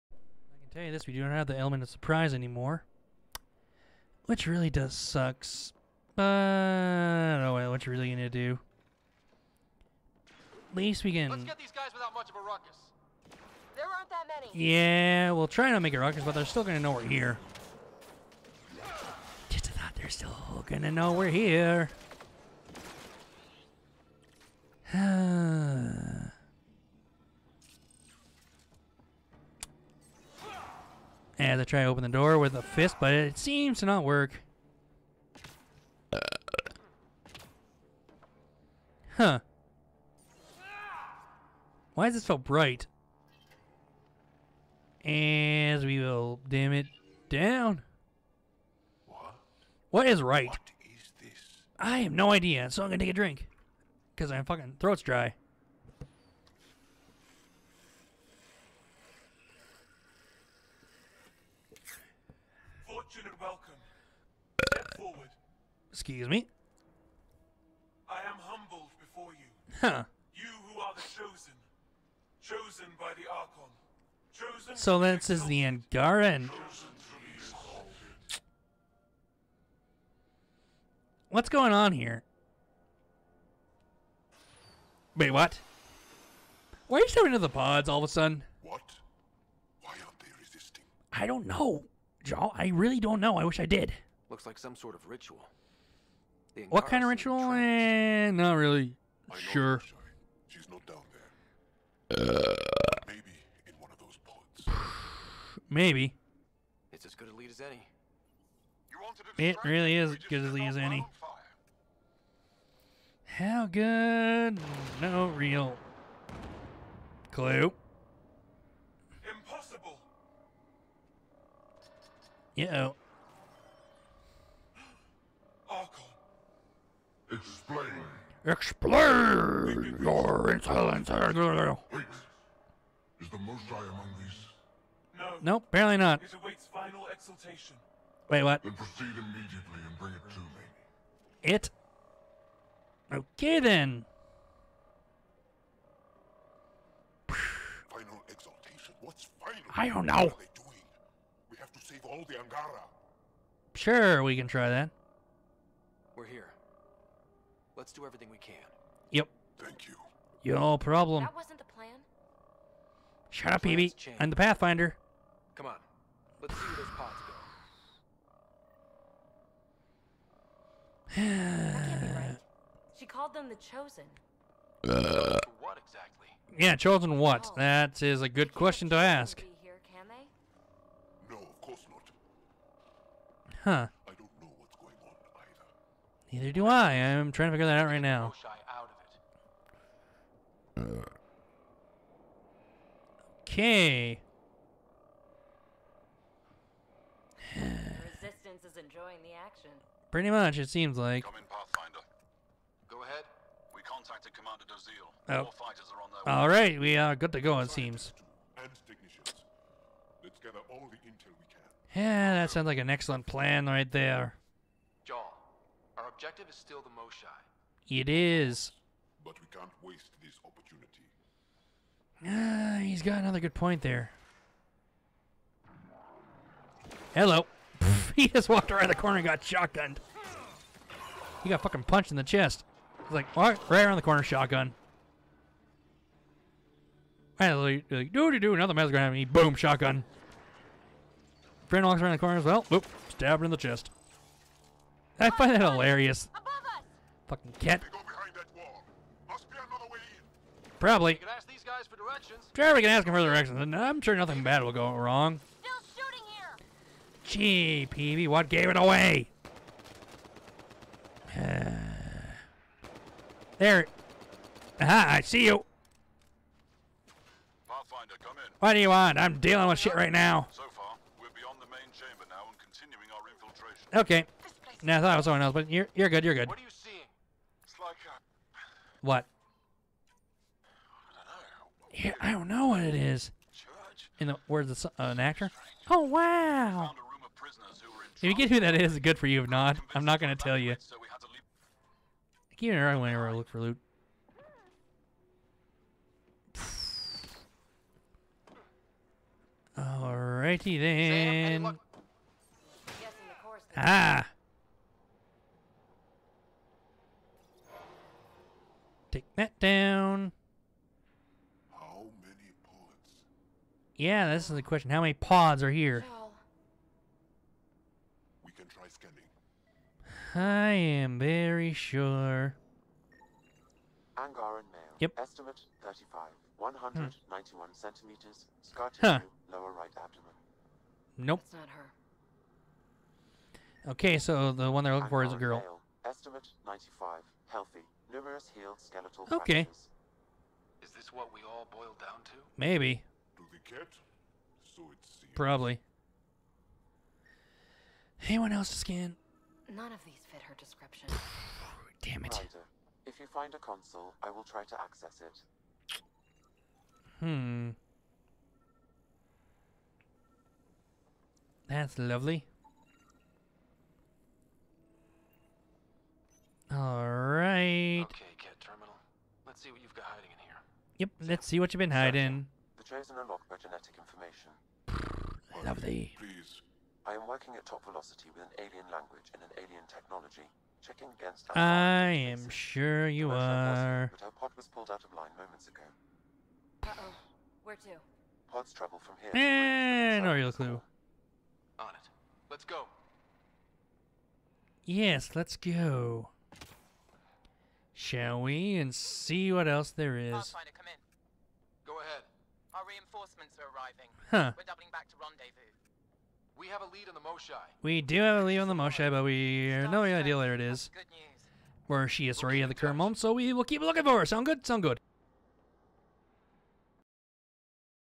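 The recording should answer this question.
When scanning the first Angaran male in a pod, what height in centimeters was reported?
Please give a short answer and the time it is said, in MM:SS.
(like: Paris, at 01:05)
191, at 05:26.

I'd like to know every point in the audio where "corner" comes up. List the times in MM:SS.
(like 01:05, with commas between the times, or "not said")
03:48, 03:54, 04:02.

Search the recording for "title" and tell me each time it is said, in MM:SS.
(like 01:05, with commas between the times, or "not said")
not said.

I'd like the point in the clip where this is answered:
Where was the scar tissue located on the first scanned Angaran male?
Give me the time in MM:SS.
05:29.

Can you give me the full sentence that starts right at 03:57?
And like, do another man's gonna have me.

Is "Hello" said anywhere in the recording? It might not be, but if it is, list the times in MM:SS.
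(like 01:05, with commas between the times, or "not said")
03:47.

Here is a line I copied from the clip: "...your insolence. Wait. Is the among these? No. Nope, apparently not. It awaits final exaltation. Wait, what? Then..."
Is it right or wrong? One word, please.
right.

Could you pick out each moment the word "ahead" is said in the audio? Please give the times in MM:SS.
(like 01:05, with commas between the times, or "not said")
03:23, 06:42.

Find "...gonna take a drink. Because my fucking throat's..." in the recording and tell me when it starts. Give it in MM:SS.
00:52.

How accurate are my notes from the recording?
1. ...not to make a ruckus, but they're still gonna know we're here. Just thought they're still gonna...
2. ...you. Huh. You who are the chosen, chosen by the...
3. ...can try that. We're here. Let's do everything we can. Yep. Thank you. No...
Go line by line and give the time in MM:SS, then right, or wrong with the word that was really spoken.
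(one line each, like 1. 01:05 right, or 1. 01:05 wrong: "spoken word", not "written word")
1. 00:15 right
2. 01:09 right
3. 02:34 right.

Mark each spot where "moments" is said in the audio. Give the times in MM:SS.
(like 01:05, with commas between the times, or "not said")
06:25, 06:52.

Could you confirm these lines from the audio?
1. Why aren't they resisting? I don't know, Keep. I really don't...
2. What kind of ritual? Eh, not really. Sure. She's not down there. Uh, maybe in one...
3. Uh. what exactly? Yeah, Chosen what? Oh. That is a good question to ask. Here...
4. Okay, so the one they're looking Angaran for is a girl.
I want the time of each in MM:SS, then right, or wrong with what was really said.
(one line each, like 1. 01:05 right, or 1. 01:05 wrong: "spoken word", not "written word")
1. 01:29 wrong: "Jaal", not "Keep"
2. 01:36 right
3. 02:54 right
4. 05:33 right.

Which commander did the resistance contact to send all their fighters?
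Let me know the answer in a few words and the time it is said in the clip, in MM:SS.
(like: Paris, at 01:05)
Commander Dozil, at 03:24.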